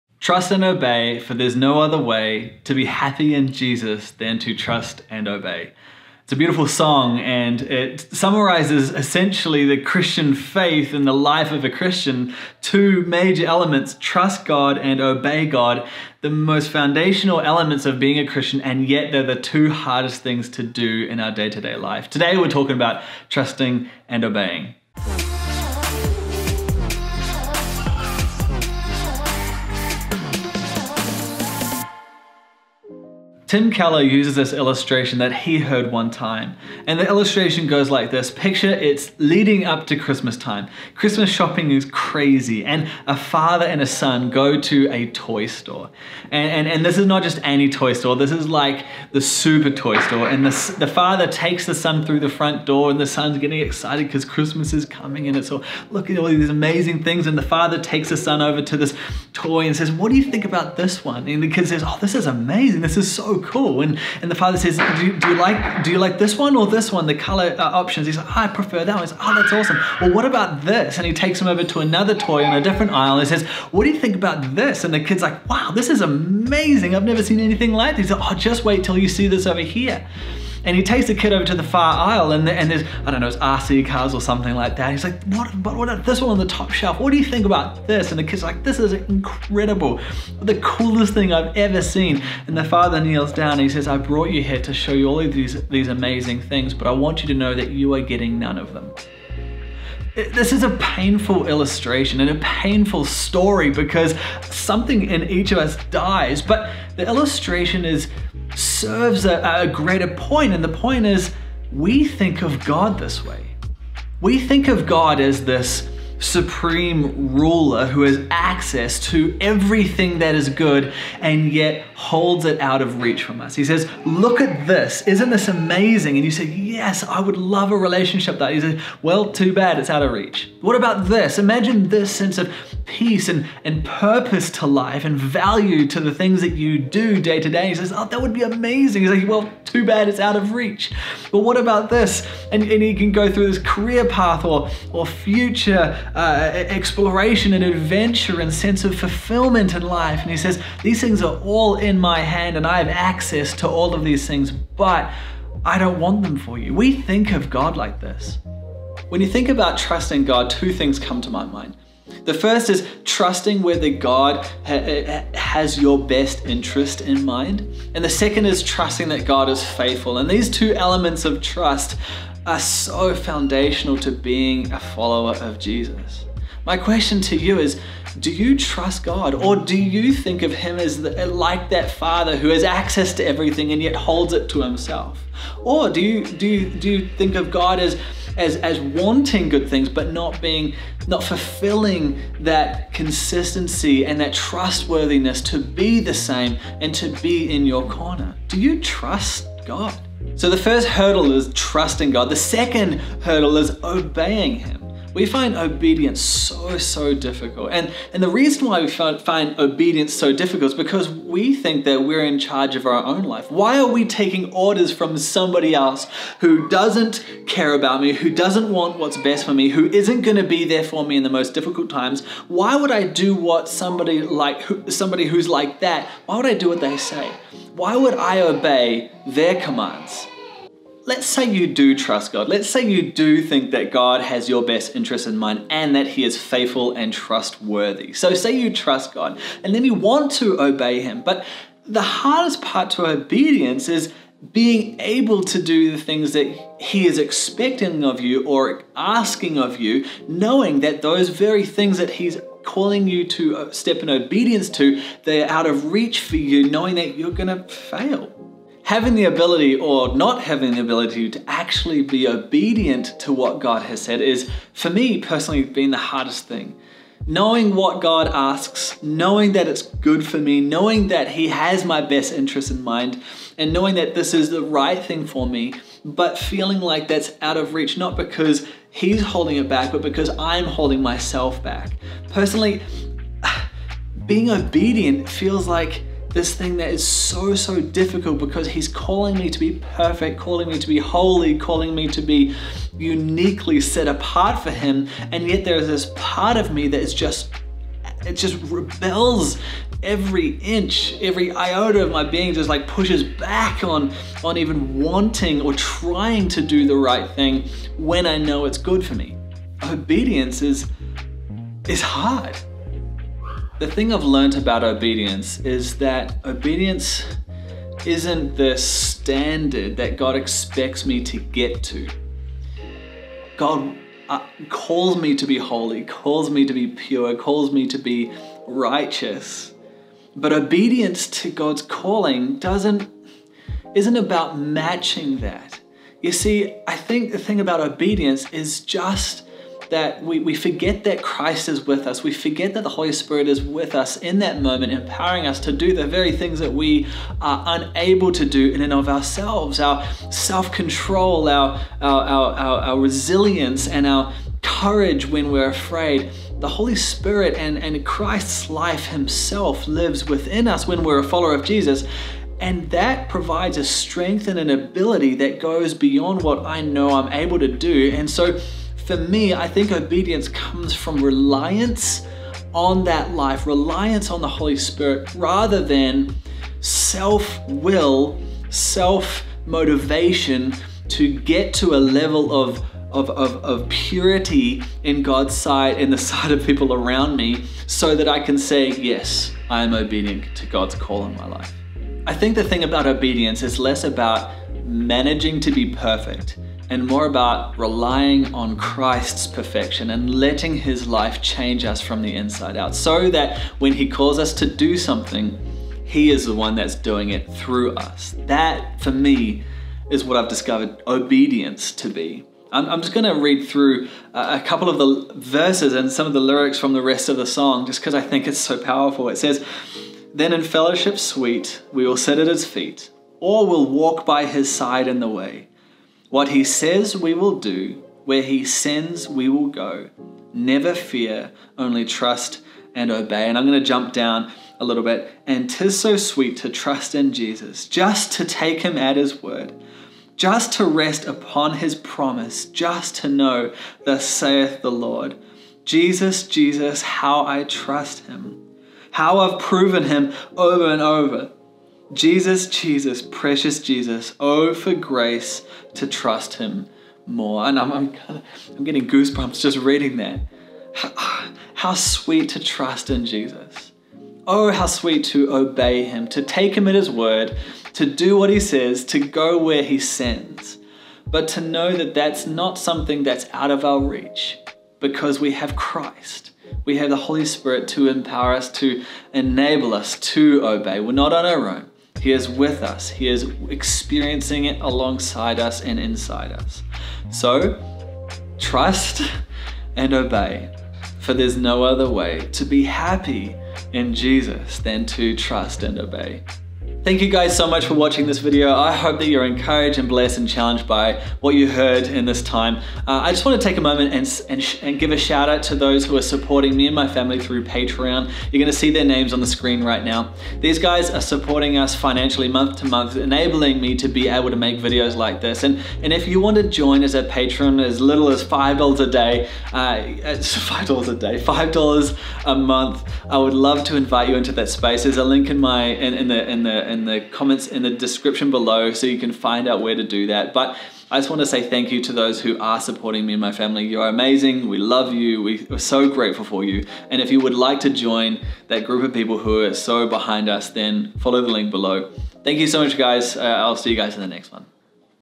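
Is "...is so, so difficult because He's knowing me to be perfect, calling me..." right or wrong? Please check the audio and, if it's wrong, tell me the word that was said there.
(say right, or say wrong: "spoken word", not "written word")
wrong: "calling", not "knowing".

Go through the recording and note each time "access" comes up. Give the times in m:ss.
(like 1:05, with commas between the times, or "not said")
1:58, 2:32, 3:02.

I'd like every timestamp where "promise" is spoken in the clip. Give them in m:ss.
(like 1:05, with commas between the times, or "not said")
7:21.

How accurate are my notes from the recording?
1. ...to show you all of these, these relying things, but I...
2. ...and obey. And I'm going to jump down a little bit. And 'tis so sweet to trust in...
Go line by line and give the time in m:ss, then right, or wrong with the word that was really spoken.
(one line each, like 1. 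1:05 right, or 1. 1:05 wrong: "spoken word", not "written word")
1. 1:34 wrong: "amazing", not "relying"
2. 7:12 right.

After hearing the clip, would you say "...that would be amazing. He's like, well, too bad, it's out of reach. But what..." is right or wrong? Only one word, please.
right.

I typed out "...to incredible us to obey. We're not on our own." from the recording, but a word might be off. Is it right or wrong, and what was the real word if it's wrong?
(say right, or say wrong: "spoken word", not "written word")
wrong: "enable", not "incredible".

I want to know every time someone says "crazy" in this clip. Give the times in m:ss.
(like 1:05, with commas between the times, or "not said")
0:41.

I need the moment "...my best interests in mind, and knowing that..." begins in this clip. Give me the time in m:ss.
4:31.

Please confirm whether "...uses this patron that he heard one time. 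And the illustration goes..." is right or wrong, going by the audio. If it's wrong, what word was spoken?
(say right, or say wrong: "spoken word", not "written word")
wrong: "illustration", not "patron".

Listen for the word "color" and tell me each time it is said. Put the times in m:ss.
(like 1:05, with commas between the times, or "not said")
1:07.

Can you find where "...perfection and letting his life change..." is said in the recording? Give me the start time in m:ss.
6:39.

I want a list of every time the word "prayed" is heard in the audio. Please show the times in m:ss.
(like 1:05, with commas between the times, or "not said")
not said.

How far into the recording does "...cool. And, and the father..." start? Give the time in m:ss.
1:03.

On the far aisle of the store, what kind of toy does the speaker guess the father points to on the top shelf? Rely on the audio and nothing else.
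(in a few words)
RC cars.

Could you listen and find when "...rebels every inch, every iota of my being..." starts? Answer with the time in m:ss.
4:58.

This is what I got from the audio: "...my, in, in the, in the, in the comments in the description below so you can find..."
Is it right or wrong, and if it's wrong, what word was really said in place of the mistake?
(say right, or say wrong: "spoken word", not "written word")
right.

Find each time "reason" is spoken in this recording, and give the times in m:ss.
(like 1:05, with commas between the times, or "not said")
3:28.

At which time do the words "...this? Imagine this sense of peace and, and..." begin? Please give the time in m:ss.
2:11.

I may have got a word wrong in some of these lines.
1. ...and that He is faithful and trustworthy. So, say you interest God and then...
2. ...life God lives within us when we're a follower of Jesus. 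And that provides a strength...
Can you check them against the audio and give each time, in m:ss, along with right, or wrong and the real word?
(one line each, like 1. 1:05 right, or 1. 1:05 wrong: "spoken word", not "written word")
1. 3:55 wrong: "trust", not "interest"
2. 5:58 wrong: "Himself", not "God".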